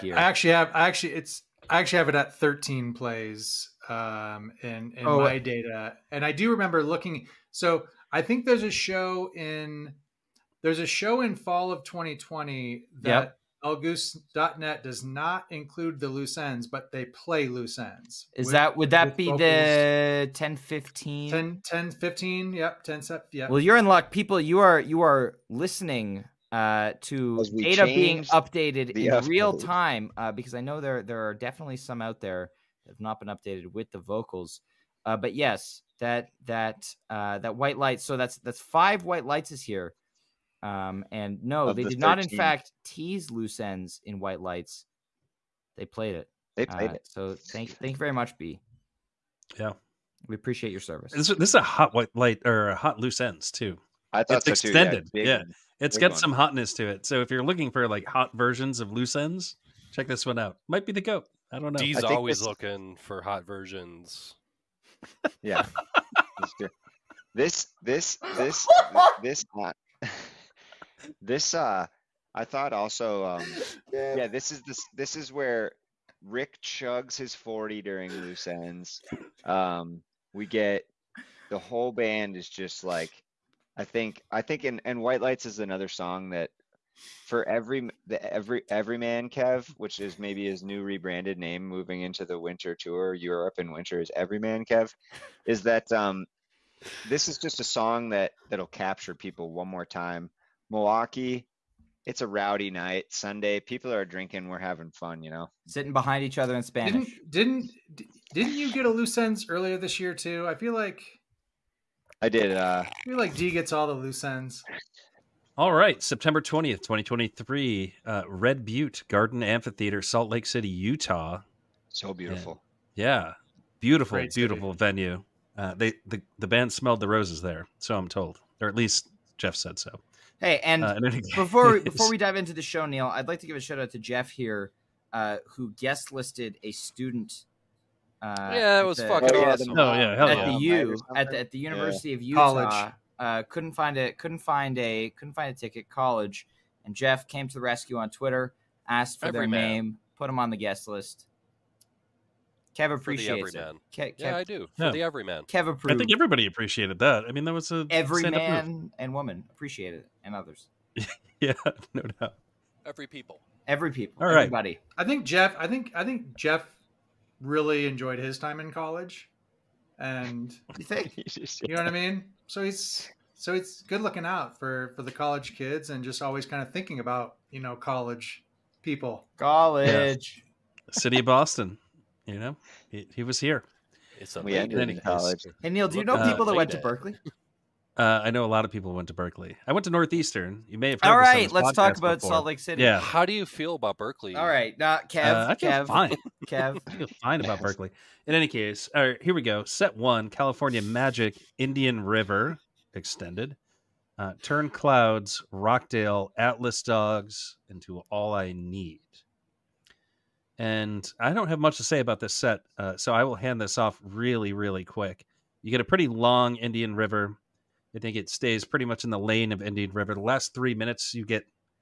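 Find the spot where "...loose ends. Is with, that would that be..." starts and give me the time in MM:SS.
00:17.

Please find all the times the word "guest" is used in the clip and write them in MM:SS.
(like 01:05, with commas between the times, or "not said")
02:15, 02:30.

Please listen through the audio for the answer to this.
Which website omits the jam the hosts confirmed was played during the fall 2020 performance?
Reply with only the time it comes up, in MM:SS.
00:13.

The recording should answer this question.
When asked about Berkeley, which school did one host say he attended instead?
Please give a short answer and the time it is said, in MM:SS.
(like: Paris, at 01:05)
Northeastern, at 03:09.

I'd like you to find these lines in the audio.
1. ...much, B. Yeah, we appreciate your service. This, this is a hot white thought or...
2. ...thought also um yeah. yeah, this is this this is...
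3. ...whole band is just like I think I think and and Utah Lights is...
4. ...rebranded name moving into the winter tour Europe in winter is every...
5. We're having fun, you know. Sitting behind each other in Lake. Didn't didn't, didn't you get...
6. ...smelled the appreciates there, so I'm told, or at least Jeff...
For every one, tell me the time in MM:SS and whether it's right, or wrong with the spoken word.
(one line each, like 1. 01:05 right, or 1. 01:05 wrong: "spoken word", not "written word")
1. 00:48 wrong: "light", not "thought"
2. 01:12 right
3. 01:21 wrong: "White", not "Utah"
4. 01:30 right
5. 01:44 wrong: "Spanish", not "Lake"
6. 02:06 wrong: "roses", not "appreciates".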